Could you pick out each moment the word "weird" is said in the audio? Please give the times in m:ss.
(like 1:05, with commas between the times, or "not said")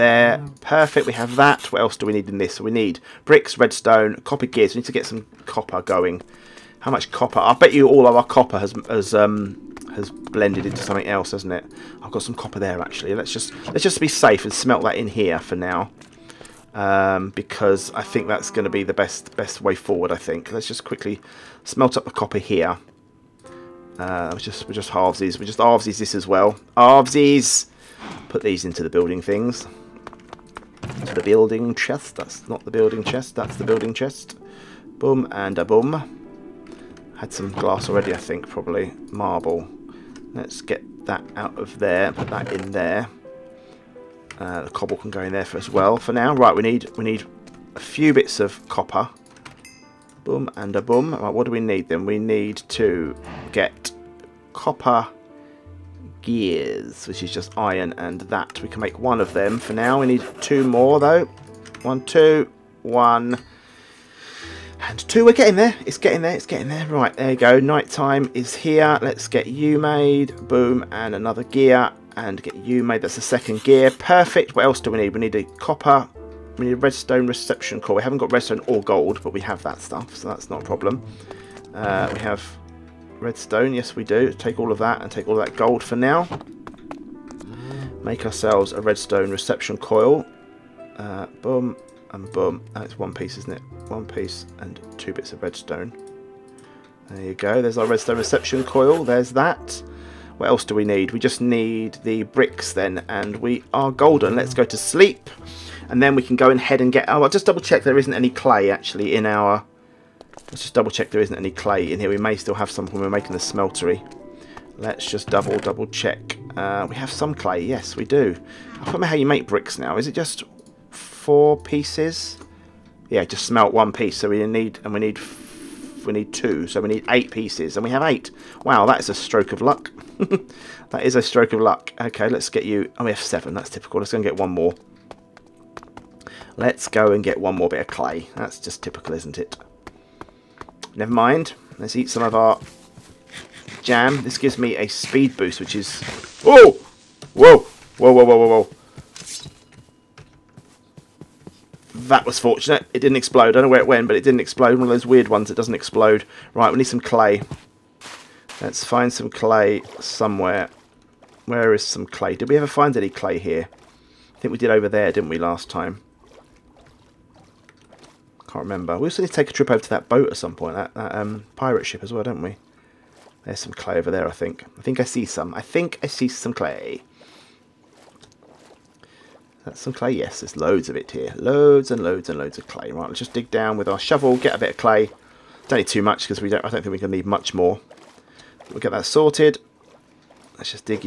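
2:35.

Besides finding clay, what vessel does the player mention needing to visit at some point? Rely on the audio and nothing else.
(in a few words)
pirate ship.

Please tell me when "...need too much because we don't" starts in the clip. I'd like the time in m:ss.
3:05.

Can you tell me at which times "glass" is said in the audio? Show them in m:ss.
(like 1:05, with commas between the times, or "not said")
0:37.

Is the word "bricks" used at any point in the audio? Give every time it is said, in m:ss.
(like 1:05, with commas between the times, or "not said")
0:03, 1:42, 1:59.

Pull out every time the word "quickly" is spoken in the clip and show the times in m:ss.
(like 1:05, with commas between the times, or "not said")
0:20.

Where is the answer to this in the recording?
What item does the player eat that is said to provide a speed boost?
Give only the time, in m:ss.
2:23.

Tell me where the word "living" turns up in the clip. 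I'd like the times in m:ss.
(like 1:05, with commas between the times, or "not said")
not said.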